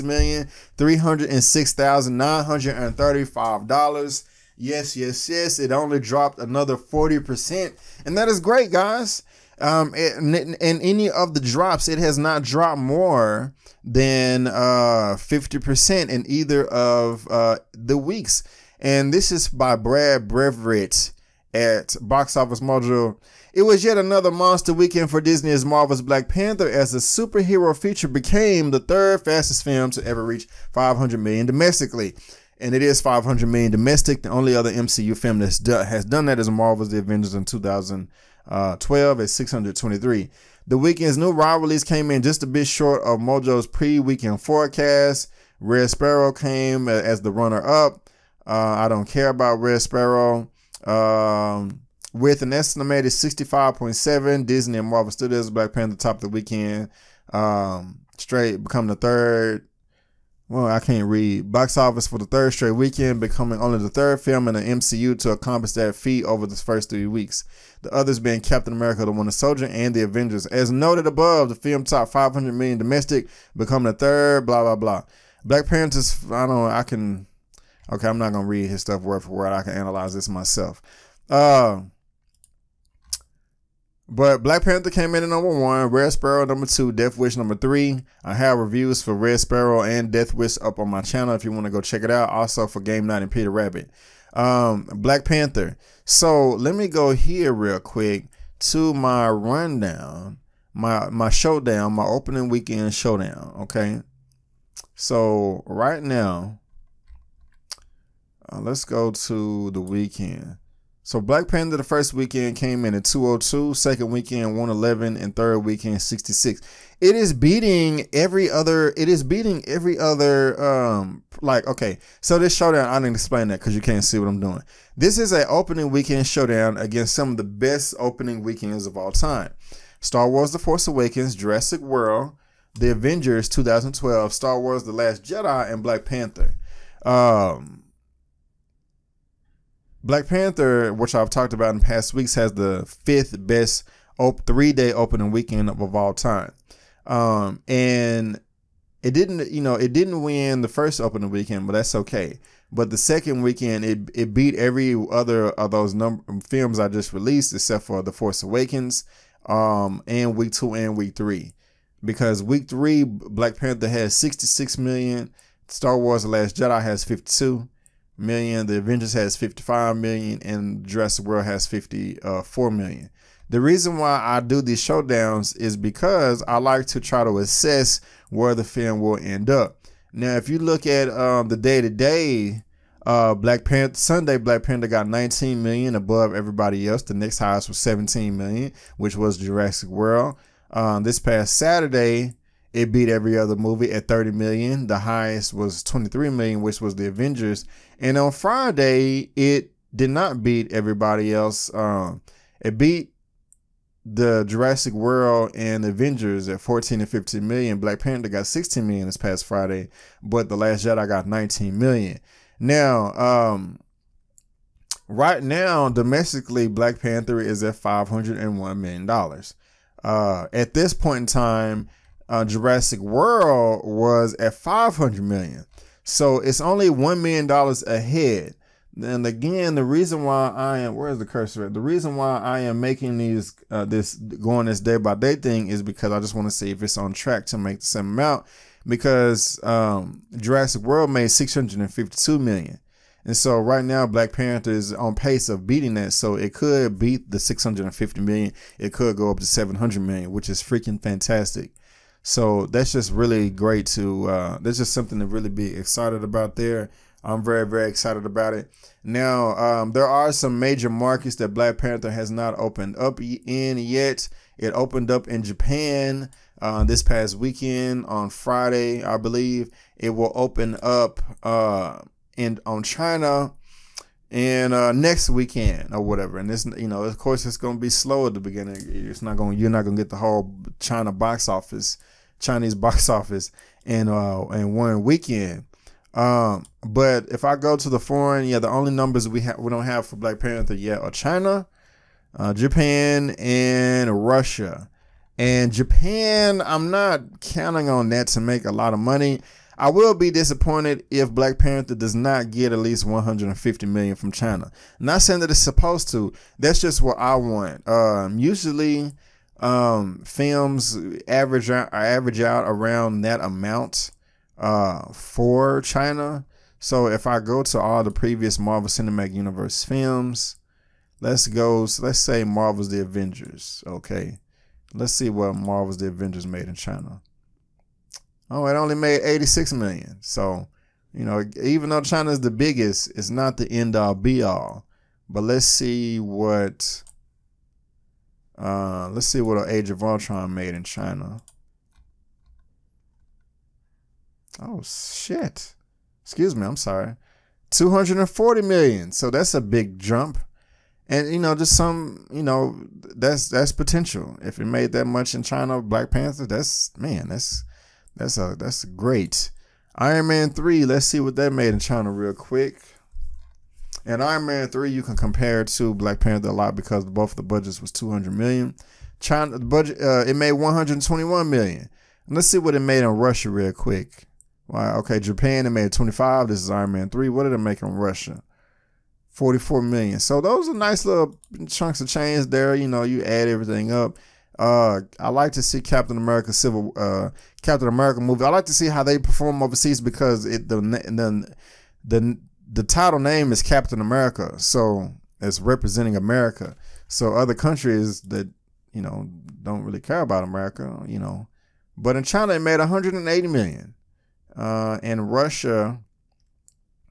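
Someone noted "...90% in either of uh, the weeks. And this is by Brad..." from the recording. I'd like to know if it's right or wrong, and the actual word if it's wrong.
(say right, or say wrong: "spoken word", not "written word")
wrong: "50", not "90".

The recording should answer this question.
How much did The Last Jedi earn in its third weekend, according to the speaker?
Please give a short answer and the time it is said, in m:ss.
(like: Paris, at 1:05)
52 million, at 2:47.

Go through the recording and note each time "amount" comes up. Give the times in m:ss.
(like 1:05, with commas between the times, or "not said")
3:58, 5:13.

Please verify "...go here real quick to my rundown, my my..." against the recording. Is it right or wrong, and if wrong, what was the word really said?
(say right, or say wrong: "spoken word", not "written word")
right.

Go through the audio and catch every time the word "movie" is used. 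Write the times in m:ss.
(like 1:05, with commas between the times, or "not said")
3:13, 6:28.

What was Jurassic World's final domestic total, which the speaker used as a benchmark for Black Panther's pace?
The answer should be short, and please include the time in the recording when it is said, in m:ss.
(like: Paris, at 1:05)
652 million, at 4:01.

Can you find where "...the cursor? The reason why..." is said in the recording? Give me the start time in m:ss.
3:51.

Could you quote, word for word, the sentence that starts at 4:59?
I will be disappointed if Black Panther does not get at least 150 million from China.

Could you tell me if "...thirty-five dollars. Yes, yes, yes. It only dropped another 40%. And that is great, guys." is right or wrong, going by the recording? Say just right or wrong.
right.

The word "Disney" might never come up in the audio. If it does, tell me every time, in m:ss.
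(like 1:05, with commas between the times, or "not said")
0:25, 0:54.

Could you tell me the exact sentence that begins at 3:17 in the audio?
And on Friday, it did not beat everybody else.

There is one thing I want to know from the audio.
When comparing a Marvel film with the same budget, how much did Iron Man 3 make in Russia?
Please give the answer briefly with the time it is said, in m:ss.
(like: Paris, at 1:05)
44 million, at 6:19.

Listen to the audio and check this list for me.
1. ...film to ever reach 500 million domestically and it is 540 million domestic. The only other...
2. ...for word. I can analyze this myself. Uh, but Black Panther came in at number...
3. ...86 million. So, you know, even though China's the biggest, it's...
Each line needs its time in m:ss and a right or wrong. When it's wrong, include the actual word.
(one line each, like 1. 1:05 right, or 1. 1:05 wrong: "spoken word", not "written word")
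1. 0:29 wrong: "500", not "540"
2. 1:19 right
3. 5:29 right.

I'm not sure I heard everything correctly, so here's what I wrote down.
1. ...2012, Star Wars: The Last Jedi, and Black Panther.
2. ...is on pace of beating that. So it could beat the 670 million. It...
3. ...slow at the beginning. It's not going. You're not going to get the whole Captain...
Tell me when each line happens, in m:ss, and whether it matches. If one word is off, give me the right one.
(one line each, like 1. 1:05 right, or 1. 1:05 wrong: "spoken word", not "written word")
1. 2:13 right
2. 4:04 wrong: "650", not "670"
3. 4:37 wrong: "China", not "Captain".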